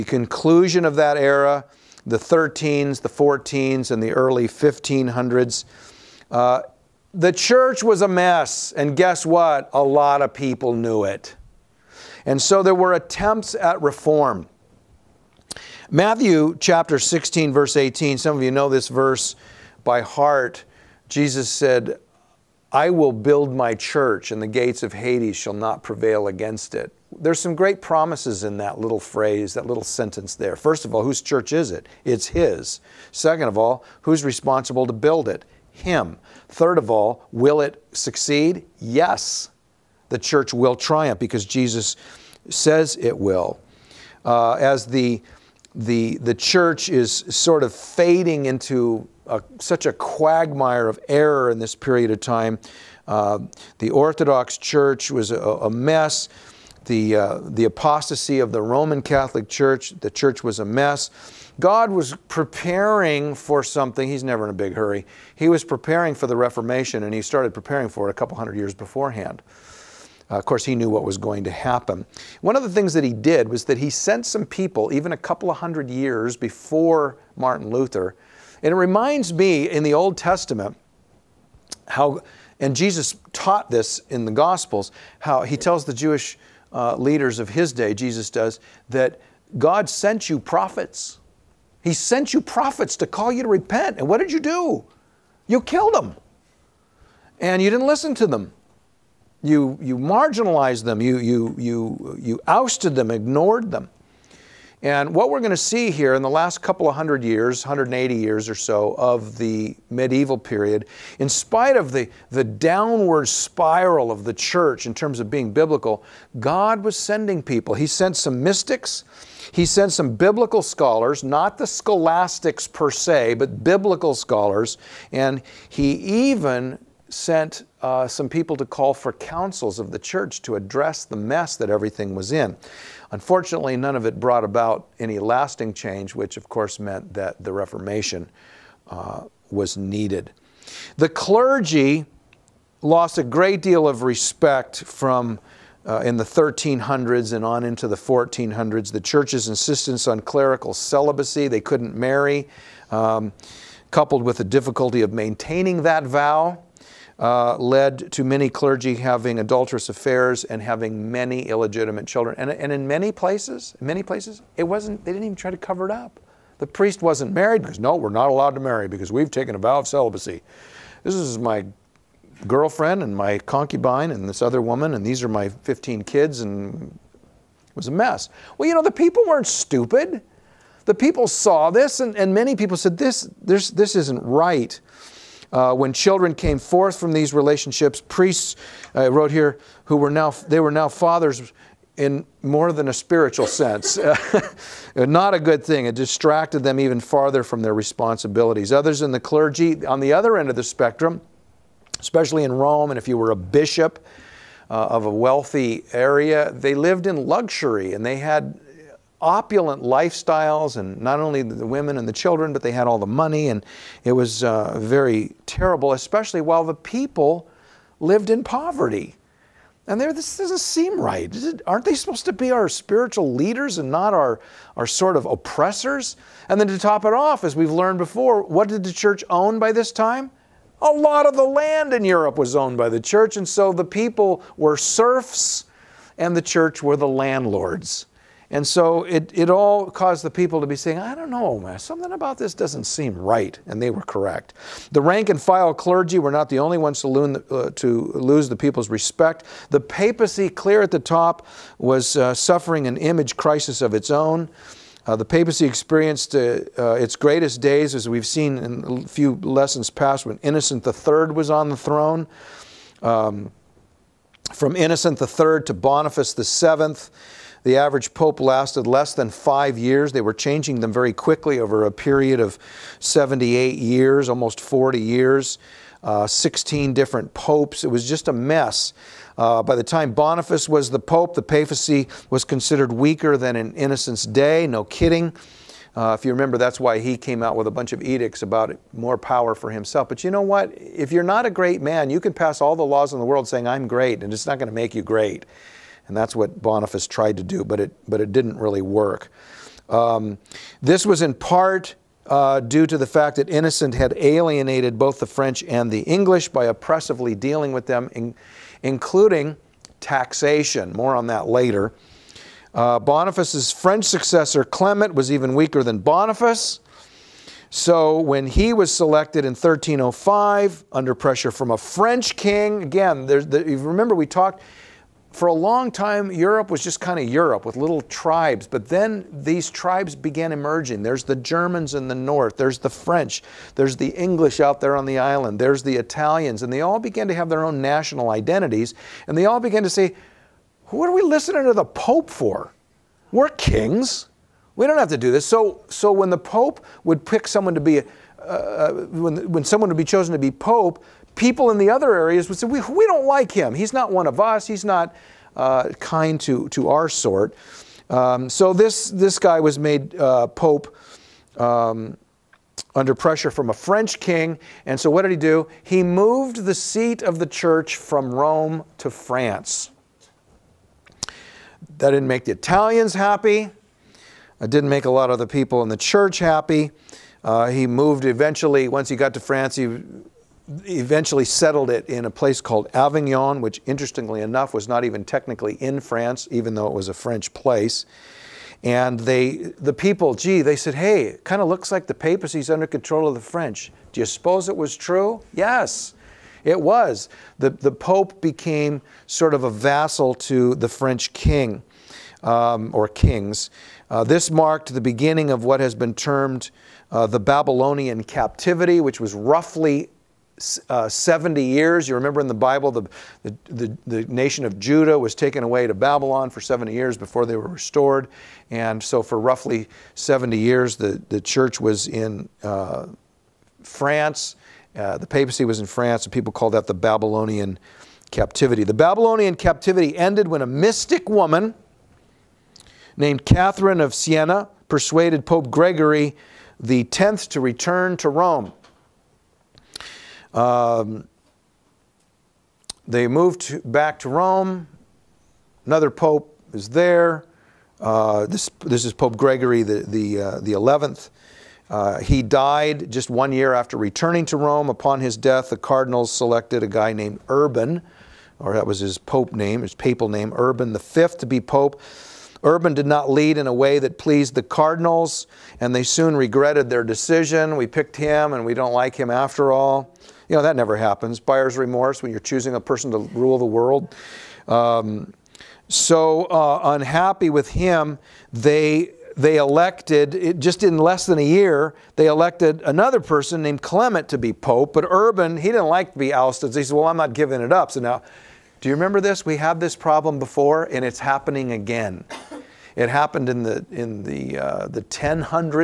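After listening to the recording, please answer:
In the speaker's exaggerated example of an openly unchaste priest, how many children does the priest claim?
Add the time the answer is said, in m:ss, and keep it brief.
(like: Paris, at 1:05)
15, at 2:55.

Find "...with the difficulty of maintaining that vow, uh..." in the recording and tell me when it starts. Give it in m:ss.
2:34.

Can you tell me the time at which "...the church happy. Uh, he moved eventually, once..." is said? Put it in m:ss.
6:15.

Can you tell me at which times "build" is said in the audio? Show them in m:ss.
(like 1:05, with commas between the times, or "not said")
0:23, 0:34.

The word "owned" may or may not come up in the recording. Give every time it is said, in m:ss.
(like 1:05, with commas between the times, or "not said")
3:52.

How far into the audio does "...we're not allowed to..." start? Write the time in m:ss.
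2:47.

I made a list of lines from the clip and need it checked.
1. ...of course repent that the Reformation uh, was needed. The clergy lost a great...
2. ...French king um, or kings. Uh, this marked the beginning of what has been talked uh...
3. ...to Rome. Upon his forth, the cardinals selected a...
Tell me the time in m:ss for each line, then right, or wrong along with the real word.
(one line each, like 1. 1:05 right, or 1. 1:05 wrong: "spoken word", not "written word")
1. 2:16 wrong: "meant", not "repent"
2. 6:40 wrong: "termed", not "talked"
3. 7:34 wrong: "death", not "forth".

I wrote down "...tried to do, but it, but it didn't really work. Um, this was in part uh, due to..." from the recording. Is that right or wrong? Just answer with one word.
right.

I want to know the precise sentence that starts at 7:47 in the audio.
We picked him, and we don't like him after all.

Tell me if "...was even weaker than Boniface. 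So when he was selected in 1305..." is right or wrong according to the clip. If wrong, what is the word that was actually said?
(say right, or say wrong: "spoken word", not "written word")
right.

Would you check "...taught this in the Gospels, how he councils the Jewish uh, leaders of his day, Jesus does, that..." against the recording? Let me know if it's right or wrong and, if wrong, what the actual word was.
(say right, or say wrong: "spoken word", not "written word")
wrong: "tells", not "councils".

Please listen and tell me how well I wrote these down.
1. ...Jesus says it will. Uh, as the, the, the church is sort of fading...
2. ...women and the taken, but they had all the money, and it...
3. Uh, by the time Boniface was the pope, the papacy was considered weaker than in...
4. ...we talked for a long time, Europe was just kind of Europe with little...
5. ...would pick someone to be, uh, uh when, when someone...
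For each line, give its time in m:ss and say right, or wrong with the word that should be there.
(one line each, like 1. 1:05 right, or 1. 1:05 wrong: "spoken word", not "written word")
1. 0:41 right
2. 3:31 wrong: "children", not "taken"
3. 4:39 right
4. 5:24 right
5. 5:47 right.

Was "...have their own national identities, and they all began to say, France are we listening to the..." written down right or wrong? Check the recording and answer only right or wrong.
wrong.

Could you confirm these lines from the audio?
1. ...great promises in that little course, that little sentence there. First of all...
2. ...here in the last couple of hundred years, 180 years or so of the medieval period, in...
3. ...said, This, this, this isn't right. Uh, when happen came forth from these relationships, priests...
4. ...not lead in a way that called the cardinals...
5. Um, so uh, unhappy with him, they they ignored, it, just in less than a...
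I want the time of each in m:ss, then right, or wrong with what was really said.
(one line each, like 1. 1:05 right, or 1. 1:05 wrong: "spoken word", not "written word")
1. 0:27 wrong: "phrase", not "course"
2. 1:45 right
3. 3:02 wrong: "children", not "happen"
4. 7:43 wrong: "pleased", not "called"
5. 7:54 wrong: "elected", not "ignored".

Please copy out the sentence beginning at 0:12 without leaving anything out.
And so there were attempts at reform.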